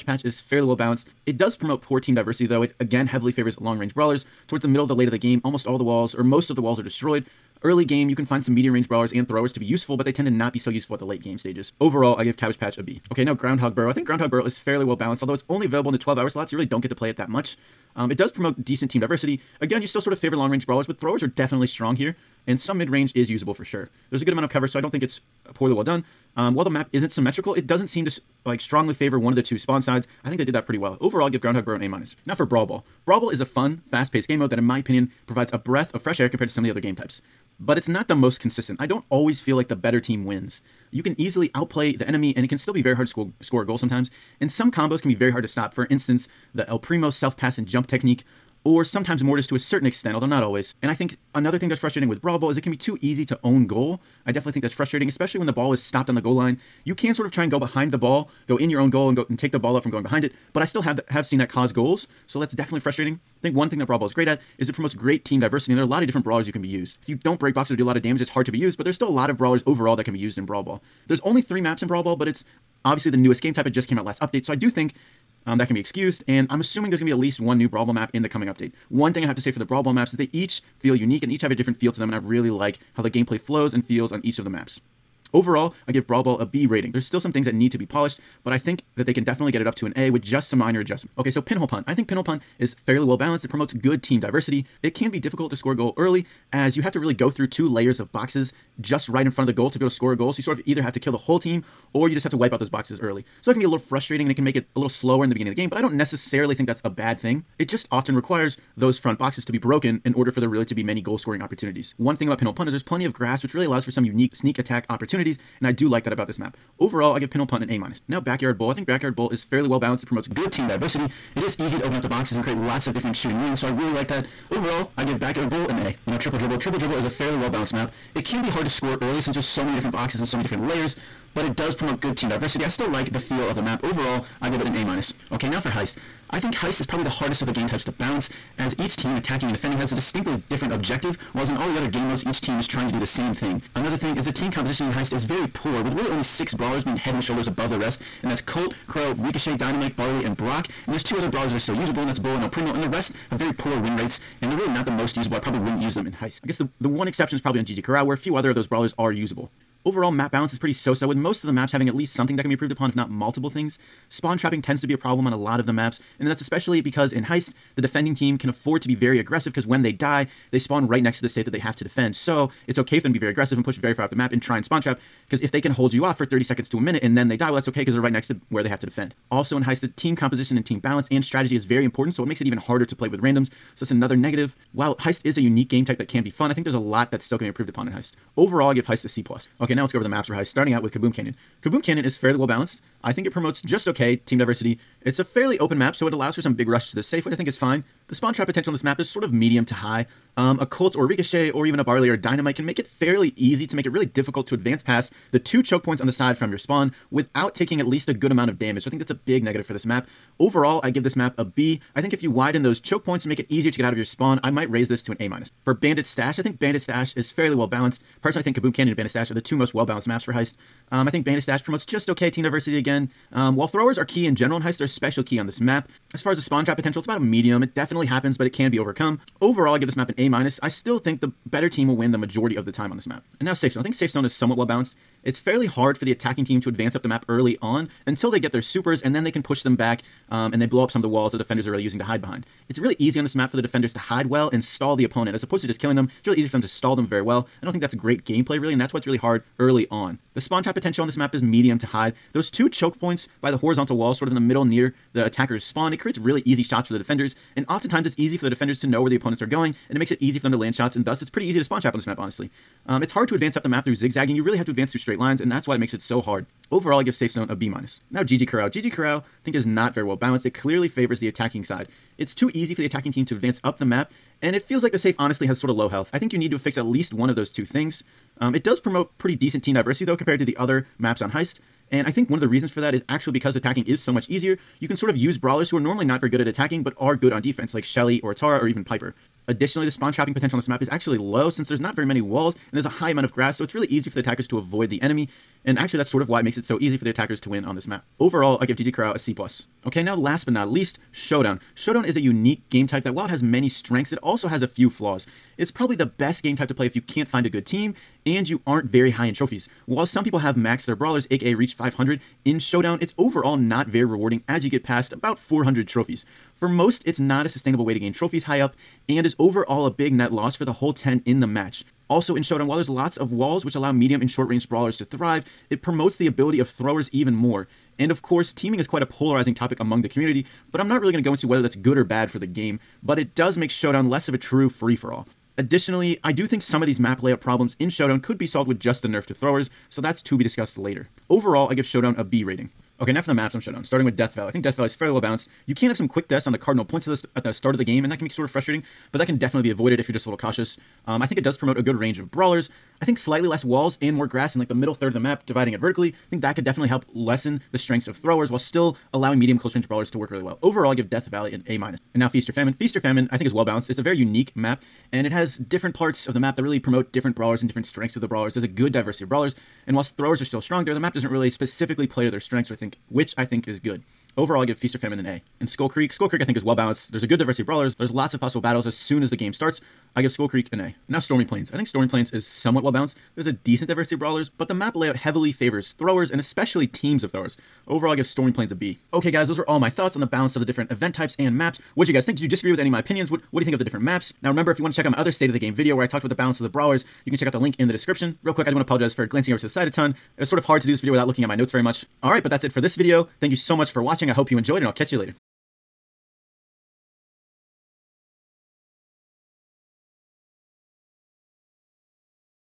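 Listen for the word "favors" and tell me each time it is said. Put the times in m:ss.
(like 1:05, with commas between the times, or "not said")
0:03, 0:20, 0:28, 4:30, 6:25.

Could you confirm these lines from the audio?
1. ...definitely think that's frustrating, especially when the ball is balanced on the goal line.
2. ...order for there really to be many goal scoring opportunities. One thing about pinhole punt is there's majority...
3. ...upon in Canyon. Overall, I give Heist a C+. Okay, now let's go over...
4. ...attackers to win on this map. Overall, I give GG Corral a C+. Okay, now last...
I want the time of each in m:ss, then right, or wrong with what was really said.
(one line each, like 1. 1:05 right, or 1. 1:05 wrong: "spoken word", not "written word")
1. 0:54 wrong: "stopped", not "balanced"
2. 1:50 wrong: "plenty", not "majority"
3. 3:07 wrong: "Heist", not "Canyon"
4. 4:57 right.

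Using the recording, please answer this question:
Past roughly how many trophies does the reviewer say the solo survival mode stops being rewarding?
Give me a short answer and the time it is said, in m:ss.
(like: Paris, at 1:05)
400, at 5:15.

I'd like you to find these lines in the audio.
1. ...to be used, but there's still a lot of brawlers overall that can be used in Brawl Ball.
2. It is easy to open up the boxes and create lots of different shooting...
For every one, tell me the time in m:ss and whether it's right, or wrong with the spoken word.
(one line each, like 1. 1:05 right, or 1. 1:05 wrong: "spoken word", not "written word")
1. 1:08 right
2. 2:01 right.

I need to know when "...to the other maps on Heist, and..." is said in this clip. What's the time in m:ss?
4:40.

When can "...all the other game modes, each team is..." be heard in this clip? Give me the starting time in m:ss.
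2:21.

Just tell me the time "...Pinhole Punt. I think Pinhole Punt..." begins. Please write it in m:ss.
1:31.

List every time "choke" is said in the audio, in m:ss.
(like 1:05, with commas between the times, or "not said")
3:25, 3:32, 4:12.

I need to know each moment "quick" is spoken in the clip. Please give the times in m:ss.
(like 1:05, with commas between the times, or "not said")
5:46, 6:38.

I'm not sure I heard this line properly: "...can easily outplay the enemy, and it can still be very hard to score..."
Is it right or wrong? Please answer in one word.
right.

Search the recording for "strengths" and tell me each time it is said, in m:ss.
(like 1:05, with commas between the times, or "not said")
5:03, 5:57, 6:07, 6:12.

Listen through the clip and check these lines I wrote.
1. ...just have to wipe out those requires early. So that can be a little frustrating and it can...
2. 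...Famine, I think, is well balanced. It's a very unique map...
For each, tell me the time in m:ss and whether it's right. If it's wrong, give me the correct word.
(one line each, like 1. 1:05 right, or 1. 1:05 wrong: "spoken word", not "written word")
1. 1:42 wrong: "boxes", not "requires"
2. 6:02 right.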